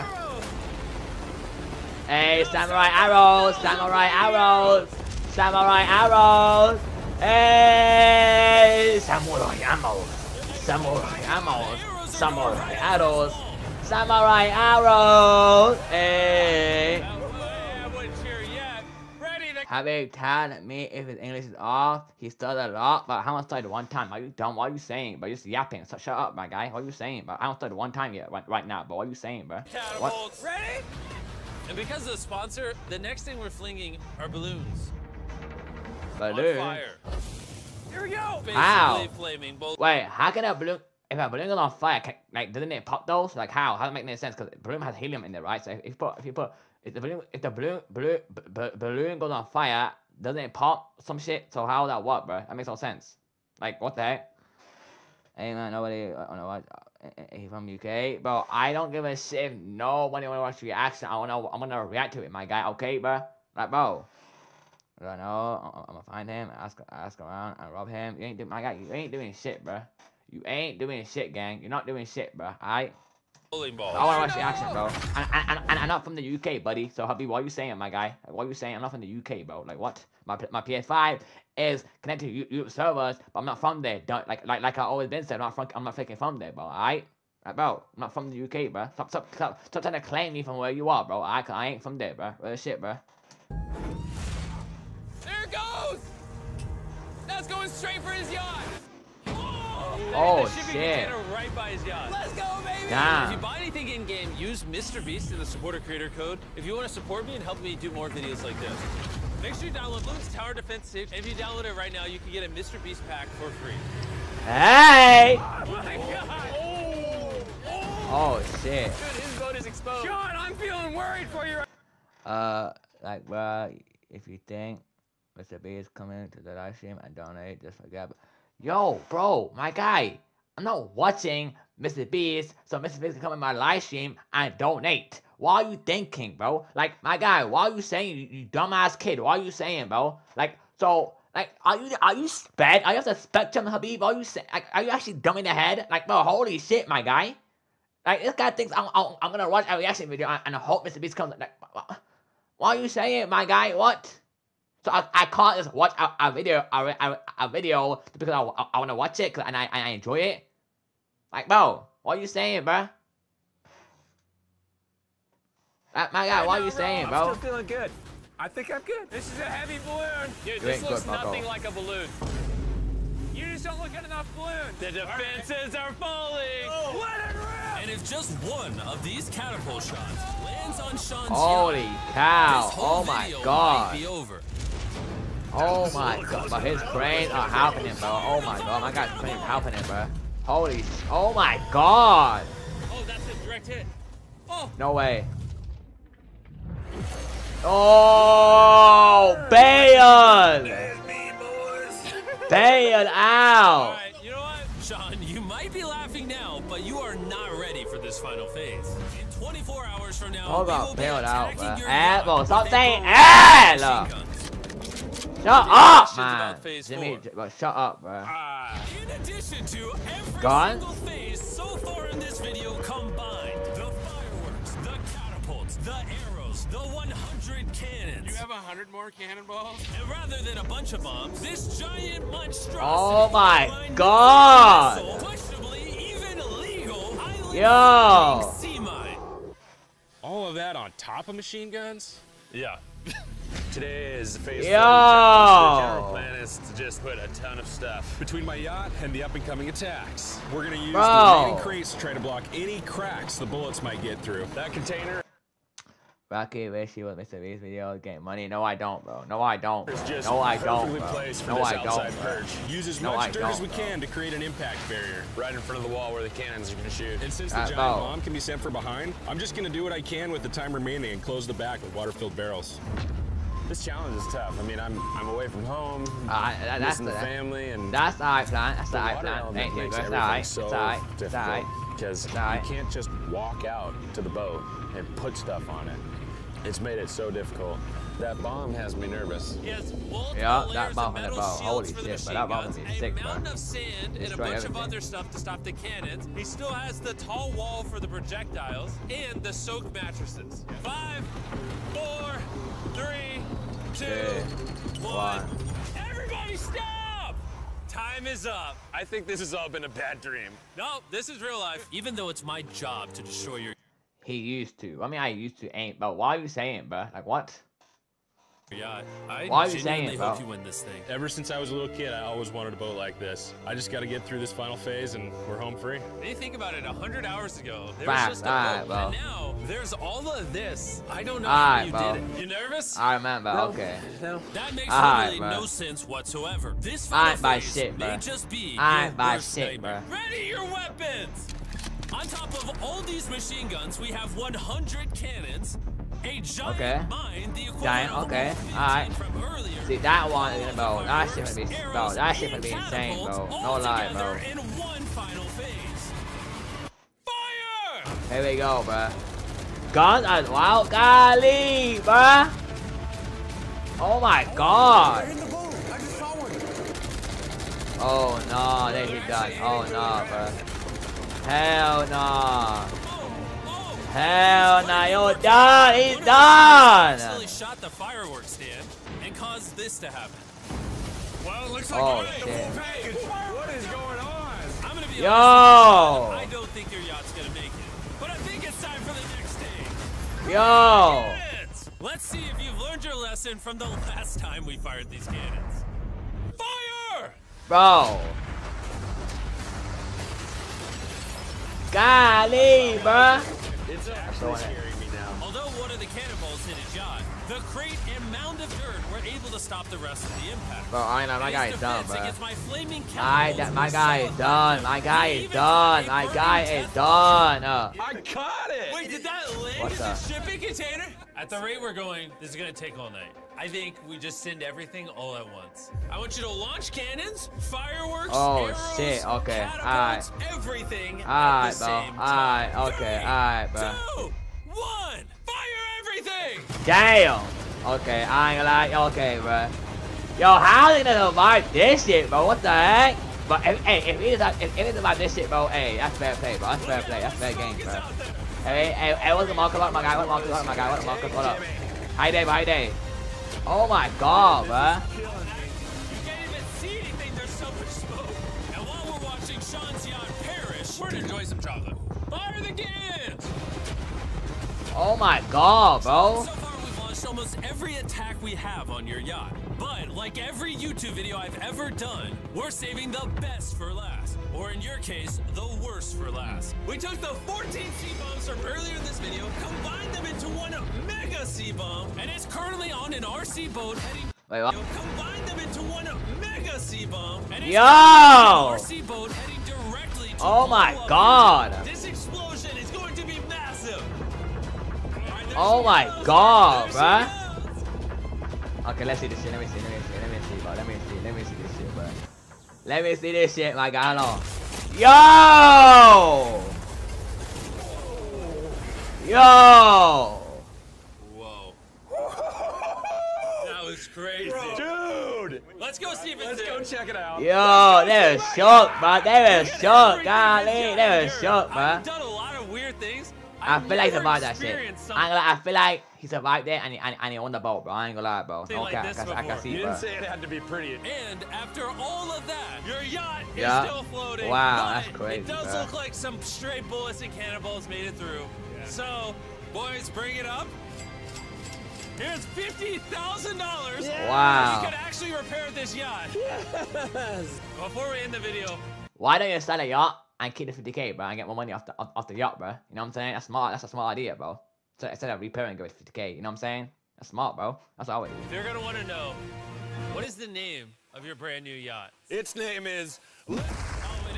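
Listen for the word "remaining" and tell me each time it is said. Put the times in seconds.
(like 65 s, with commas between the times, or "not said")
251 s, 270 s.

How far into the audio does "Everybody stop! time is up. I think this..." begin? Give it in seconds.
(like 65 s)
305 s.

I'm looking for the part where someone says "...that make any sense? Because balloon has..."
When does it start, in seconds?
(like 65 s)
43 s.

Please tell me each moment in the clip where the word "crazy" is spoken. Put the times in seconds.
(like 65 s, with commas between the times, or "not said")
514 s, 535 s.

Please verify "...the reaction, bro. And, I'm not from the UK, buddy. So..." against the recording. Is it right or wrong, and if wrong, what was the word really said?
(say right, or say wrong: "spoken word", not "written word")
wrong: "action", not "reaction".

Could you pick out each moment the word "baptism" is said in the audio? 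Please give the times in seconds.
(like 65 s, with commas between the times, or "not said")
not said.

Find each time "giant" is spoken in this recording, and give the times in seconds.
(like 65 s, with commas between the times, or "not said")
231 s, 267 s.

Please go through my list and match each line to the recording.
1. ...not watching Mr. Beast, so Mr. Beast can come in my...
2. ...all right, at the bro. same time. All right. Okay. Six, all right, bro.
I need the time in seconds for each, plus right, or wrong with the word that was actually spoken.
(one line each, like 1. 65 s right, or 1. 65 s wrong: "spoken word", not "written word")
1. 130 s right
2. 431 s wrong: "Three", not "Six".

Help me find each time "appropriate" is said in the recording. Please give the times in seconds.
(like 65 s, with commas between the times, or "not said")
not said.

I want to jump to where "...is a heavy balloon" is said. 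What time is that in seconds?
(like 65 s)
169 s.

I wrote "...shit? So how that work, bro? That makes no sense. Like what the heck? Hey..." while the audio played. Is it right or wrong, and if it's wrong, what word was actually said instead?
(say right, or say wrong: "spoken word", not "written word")
right.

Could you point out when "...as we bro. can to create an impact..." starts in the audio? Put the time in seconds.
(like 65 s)
263 s.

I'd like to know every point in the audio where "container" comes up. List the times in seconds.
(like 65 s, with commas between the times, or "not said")
254 s, 420 s.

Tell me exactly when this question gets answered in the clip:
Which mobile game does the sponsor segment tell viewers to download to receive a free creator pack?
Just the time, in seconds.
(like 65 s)
110 s.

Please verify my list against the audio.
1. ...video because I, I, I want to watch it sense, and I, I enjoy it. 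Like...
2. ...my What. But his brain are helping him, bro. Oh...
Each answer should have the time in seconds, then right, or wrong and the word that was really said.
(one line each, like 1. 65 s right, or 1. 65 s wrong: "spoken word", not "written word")
1. 157 s wrong: "cause", not "sense"
2. 185 s wrong: "God", not "What".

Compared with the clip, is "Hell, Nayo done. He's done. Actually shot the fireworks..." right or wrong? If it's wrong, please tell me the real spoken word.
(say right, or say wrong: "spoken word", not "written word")
right.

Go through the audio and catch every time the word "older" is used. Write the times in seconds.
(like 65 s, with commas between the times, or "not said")
not said.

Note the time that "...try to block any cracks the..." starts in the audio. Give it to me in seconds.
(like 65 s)
251 s.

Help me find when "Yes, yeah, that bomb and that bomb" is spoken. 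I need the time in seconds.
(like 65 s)
289 s.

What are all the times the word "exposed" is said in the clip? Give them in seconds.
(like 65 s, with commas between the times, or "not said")
119 s.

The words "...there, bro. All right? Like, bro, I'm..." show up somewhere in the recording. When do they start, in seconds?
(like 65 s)
86 s.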